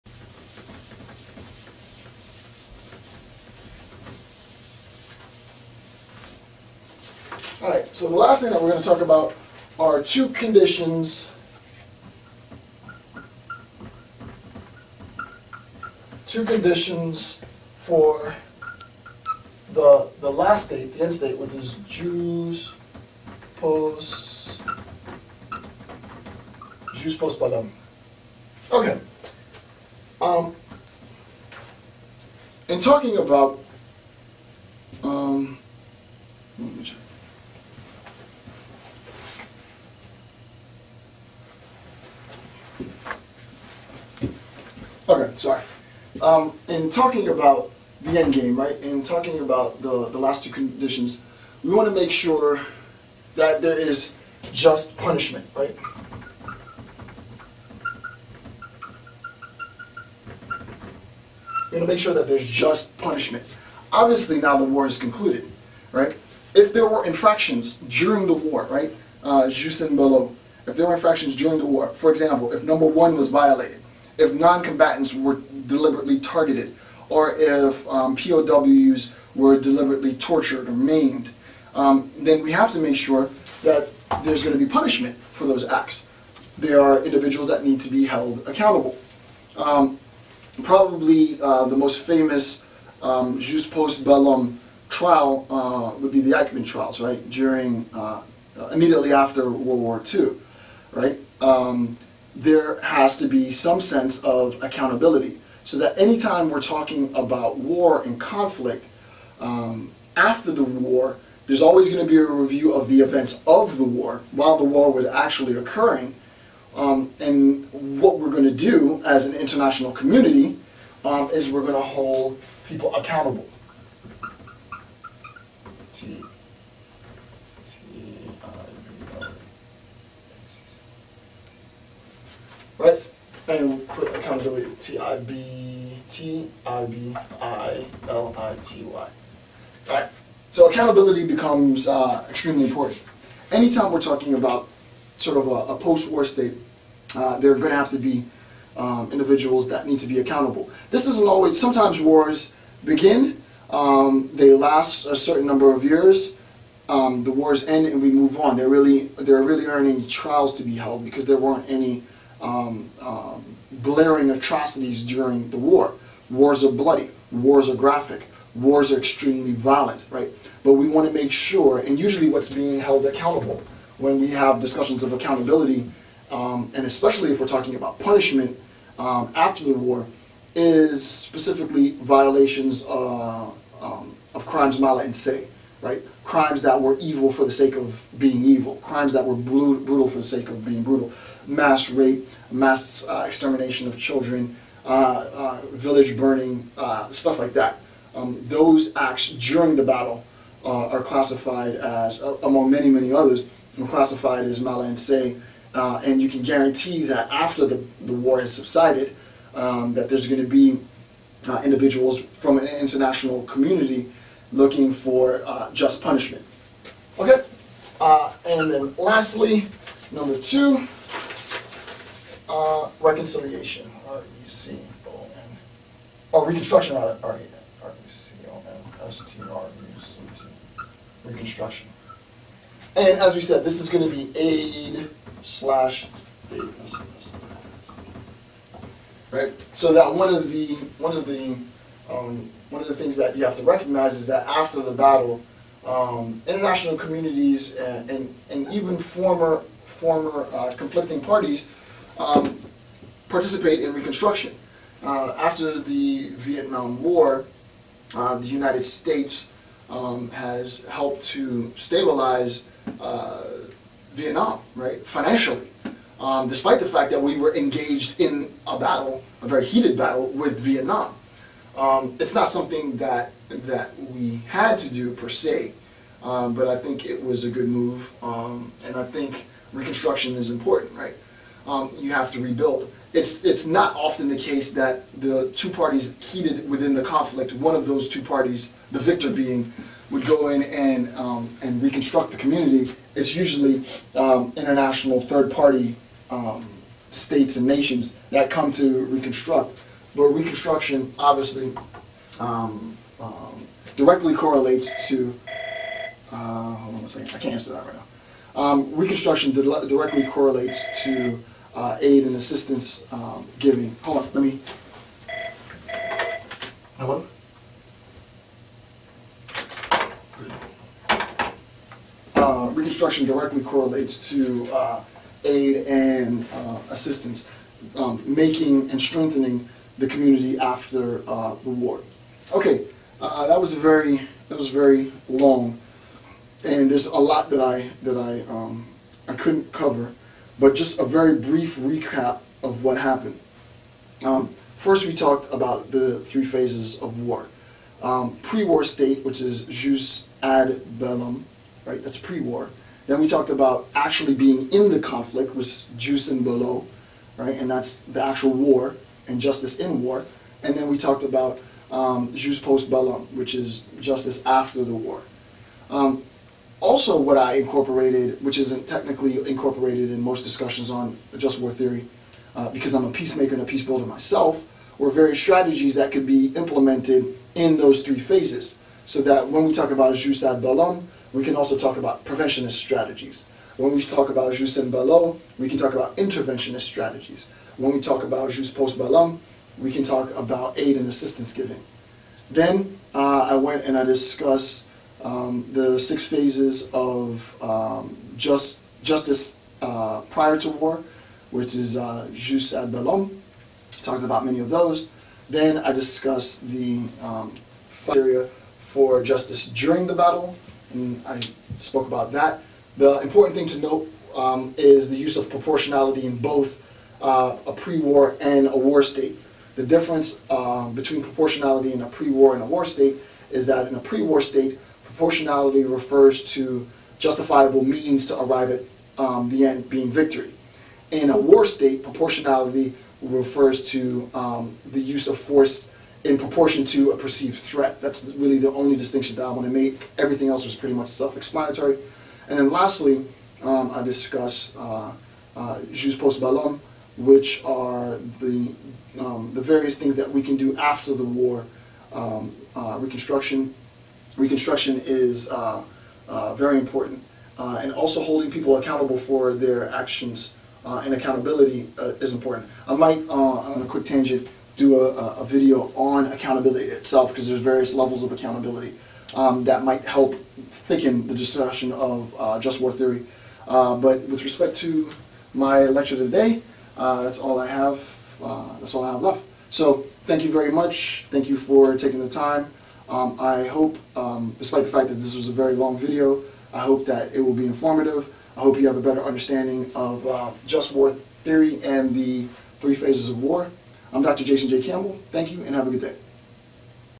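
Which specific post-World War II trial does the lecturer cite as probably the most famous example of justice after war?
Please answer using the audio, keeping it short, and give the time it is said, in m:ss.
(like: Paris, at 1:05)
Eichmann trials, at 1:36.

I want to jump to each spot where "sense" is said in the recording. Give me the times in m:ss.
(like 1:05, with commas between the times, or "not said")
1:43.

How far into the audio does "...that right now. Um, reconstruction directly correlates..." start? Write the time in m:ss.
5:07.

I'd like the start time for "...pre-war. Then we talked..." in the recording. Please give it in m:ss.
5:52.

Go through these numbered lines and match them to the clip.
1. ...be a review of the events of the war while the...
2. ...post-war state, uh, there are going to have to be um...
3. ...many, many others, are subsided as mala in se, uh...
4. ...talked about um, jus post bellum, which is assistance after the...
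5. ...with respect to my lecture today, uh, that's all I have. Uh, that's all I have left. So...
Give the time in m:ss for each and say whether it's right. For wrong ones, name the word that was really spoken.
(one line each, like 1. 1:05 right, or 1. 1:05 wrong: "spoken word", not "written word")
1. 1:52 right
2. 2:25 right
3. 3:22 wrong: "classified", not "subsided"
4. 6:00 wrong: "justice", not "assistance"
5. 7:54 right.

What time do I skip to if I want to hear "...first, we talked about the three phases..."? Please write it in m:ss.
5:44.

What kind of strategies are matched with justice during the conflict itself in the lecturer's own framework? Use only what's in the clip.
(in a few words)
interventionist strategies.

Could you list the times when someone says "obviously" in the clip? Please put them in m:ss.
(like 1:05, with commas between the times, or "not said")
1:03, 5:01.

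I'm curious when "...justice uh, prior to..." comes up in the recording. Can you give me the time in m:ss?
6:39.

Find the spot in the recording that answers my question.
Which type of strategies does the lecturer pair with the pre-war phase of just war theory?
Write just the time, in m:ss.
6:22.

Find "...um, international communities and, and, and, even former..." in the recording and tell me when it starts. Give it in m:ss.
4:05.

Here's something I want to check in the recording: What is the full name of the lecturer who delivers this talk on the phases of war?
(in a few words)
Dr. Jason J. Campbell.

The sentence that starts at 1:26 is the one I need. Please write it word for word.
There are individuals that need to be held accountable.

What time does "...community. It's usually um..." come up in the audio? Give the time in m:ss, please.
4:52.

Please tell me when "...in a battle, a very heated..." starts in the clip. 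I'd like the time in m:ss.
4:28.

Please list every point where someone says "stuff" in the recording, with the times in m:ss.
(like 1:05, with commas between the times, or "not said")
3:17.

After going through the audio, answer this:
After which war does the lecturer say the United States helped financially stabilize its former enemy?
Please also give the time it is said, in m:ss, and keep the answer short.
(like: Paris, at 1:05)
Vietnam War, at 4:16.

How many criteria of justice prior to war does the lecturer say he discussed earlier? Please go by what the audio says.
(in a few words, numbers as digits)
6.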